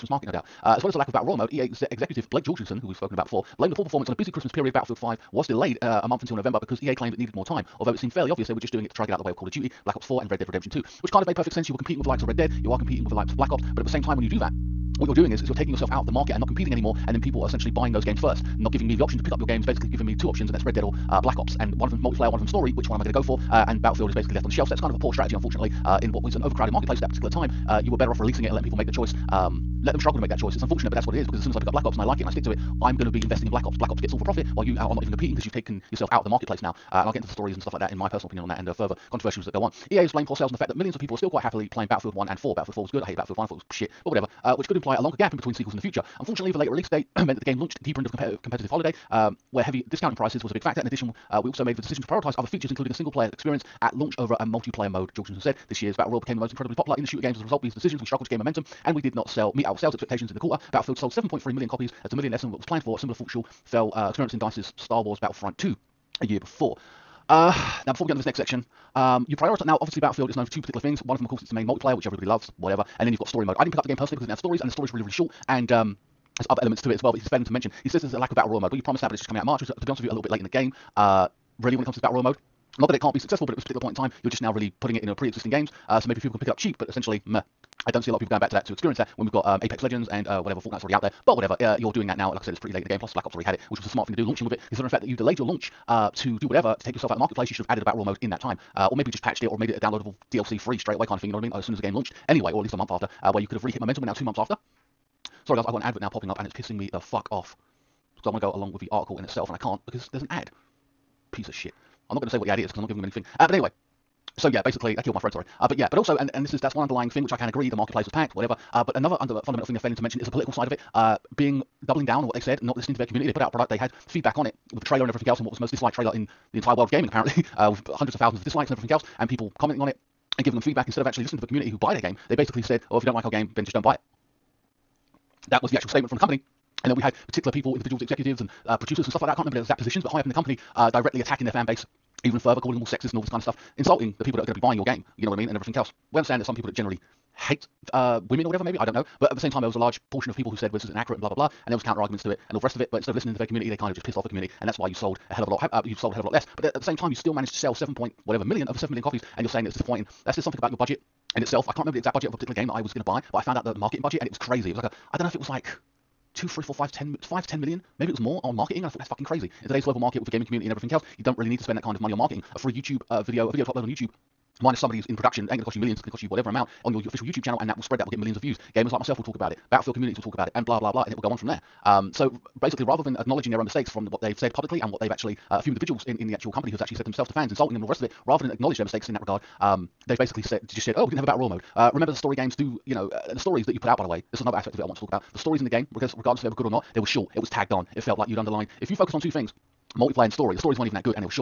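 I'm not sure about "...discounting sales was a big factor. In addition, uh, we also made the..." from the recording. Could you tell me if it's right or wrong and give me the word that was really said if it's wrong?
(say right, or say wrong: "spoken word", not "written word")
wrong: "prices", not "sales".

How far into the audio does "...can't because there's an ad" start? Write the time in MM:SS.
01:49.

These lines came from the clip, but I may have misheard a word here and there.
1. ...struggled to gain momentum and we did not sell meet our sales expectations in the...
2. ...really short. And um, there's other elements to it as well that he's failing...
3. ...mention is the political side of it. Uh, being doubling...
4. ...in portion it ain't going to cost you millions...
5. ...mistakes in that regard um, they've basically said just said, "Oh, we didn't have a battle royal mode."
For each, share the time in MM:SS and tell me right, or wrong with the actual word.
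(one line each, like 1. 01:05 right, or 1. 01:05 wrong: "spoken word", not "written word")
1. 00:58 right
2. 01:15 right
3. 02:00 right
4. 02:55 wrong: "production", not "portion"
5. 03:08 right.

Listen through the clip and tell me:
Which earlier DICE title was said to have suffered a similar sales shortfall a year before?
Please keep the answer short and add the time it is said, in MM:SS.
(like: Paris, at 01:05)
Star Wars Battlefront 2, at 01:04.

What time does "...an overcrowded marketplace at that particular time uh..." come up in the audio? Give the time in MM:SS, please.
00:26.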